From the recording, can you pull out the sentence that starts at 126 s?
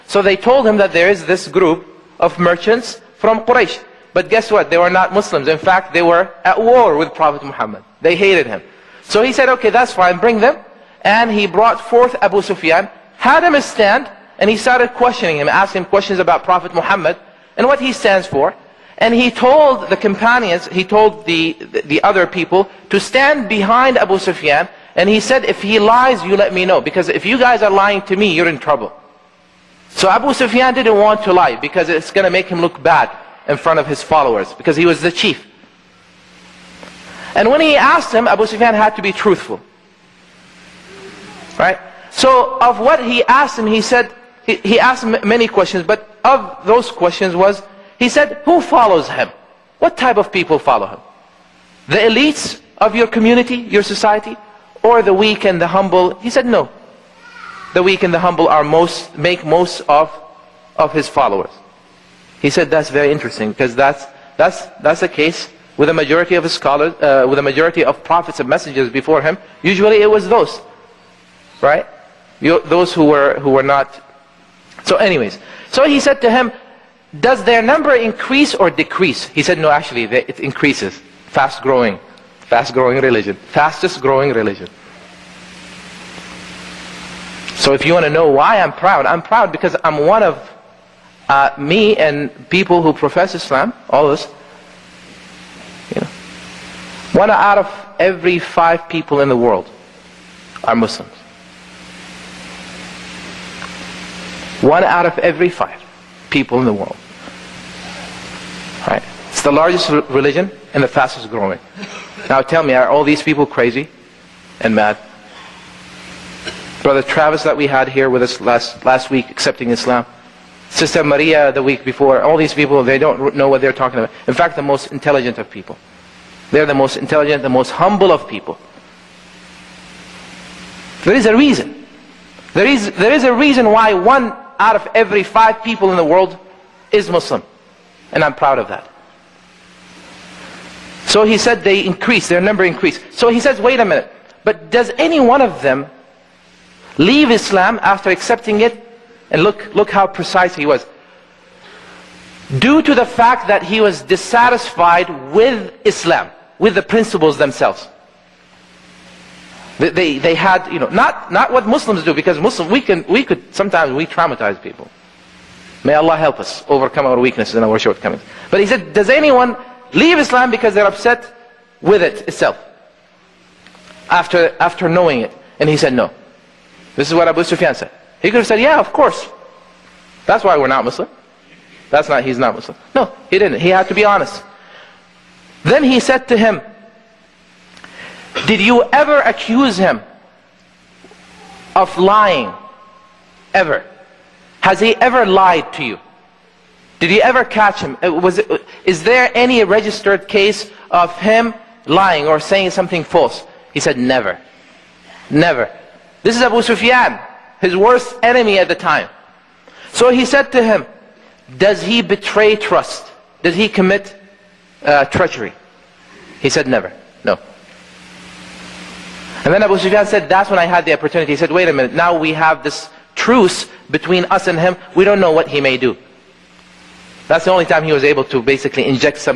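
They're the most intelligent, the most humble of people.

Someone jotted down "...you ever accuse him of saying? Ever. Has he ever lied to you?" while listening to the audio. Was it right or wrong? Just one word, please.
wrong.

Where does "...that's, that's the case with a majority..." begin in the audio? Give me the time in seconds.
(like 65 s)
64 s.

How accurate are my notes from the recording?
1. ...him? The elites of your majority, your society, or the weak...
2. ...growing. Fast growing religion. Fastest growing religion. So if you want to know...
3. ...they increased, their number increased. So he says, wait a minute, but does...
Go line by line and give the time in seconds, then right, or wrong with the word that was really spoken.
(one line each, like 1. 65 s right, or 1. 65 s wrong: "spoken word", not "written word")
1. 50 s wrong: "community", not "majority"
2. 81 s right
3. 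141 s right.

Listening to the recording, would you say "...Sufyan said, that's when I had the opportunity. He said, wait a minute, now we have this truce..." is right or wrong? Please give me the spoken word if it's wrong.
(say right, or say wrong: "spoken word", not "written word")
right.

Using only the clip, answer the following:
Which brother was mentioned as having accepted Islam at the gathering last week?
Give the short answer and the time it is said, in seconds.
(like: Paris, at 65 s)
Travis, at 116 s.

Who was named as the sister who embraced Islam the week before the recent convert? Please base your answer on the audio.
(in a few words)
Maria.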